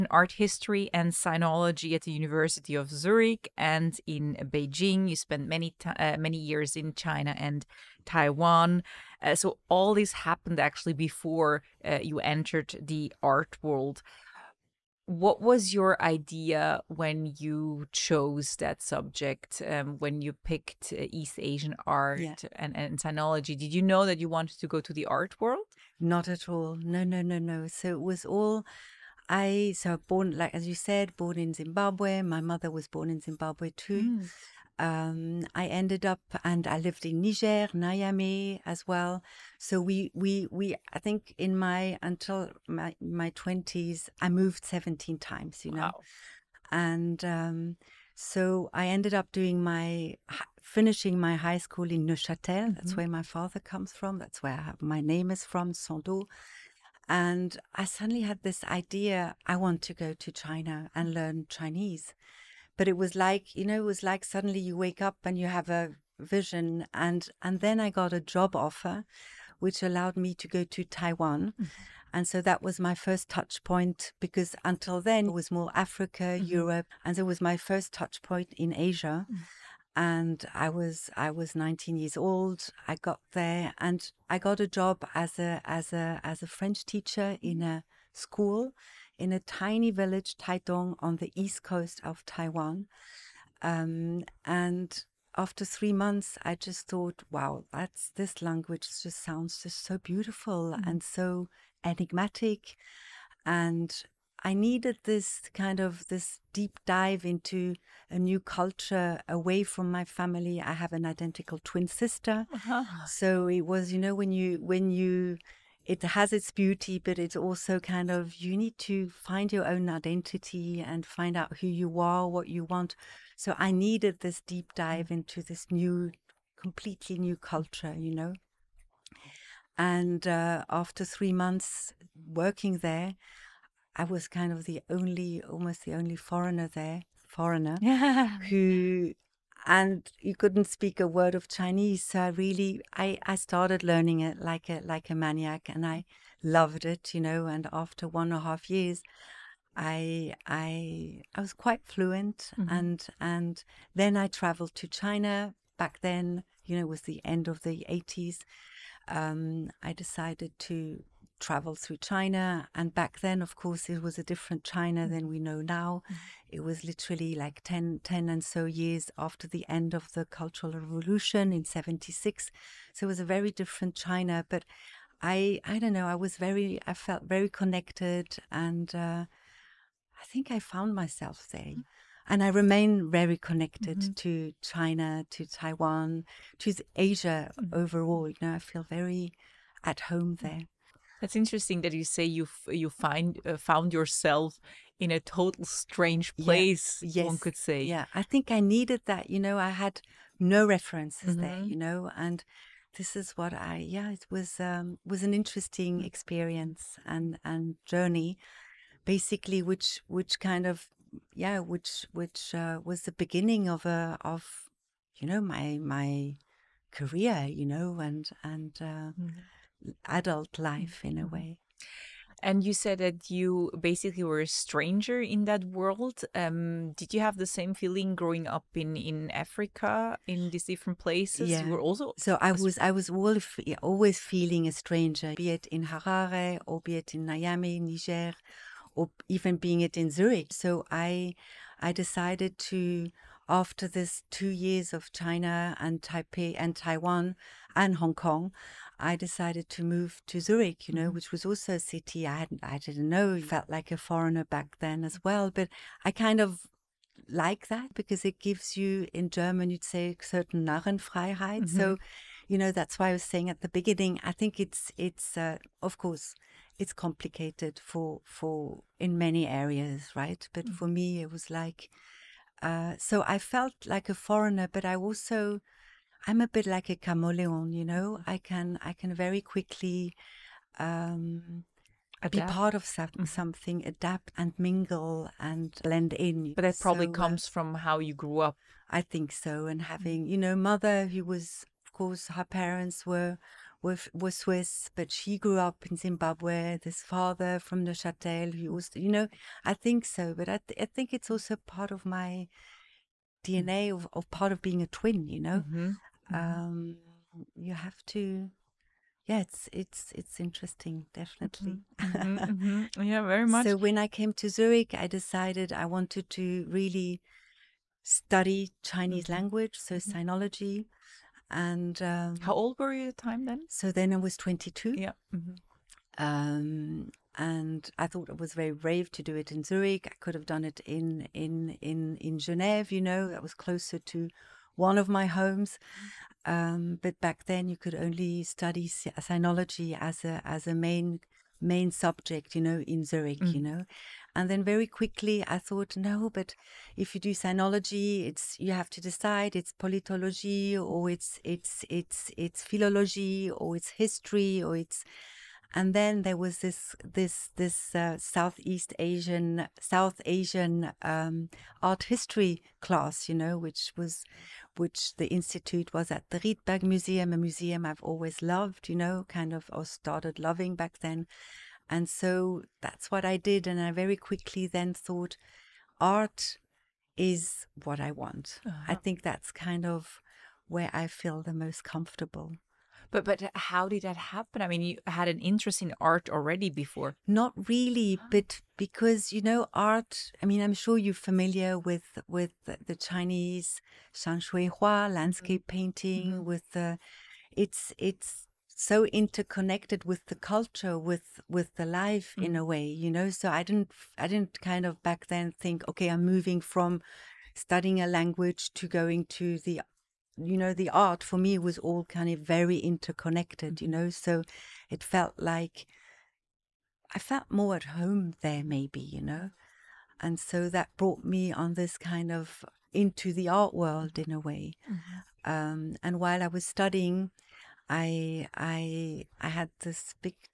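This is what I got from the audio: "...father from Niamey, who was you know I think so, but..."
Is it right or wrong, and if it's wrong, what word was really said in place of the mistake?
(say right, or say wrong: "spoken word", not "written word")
wrong: "Neuchâtel", not "Niamey".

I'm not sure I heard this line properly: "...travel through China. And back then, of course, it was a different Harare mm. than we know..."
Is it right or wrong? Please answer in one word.
wrong.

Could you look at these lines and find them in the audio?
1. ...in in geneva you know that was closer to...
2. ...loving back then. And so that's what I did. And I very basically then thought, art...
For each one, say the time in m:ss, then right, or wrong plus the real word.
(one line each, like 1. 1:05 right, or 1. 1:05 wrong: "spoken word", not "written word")
1. 5:31 right
2. 6:10 wrong: "quickly", not "basically".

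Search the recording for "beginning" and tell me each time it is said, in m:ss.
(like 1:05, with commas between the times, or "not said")
3:33, 4:23.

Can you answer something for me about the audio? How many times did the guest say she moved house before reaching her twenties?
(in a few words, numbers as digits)
17.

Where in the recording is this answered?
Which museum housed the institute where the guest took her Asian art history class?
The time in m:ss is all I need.
6:06.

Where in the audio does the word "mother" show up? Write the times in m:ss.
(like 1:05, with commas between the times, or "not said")
0:32, 4:50.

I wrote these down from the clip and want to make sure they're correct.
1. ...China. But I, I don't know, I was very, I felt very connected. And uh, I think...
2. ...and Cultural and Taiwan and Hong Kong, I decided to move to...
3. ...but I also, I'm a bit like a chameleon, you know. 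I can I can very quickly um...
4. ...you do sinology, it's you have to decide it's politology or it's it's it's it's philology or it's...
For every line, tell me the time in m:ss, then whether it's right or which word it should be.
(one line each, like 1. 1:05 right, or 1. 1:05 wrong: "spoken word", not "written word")
1. 2:53 right
2. 4:05 wrong: "Taipei", not "Cultural"
3. 4:34 right
4. 5:47 right.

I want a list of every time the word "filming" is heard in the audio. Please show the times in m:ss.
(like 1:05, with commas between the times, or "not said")
not said.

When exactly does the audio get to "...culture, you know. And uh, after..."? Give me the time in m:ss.
2:07.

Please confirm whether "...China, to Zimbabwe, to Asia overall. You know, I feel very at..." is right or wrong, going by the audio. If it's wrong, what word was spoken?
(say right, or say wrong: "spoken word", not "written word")
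wrong: "Taiwan", not "Zimbabwe".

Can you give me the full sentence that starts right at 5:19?
language so sinology and um, how old were you at the time then so then i was 22 yeah mm-hmm.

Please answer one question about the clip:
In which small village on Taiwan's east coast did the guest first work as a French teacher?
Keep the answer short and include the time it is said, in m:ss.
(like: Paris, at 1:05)
Taidong, at 1:30.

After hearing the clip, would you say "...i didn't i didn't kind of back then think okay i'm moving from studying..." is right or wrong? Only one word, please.
right.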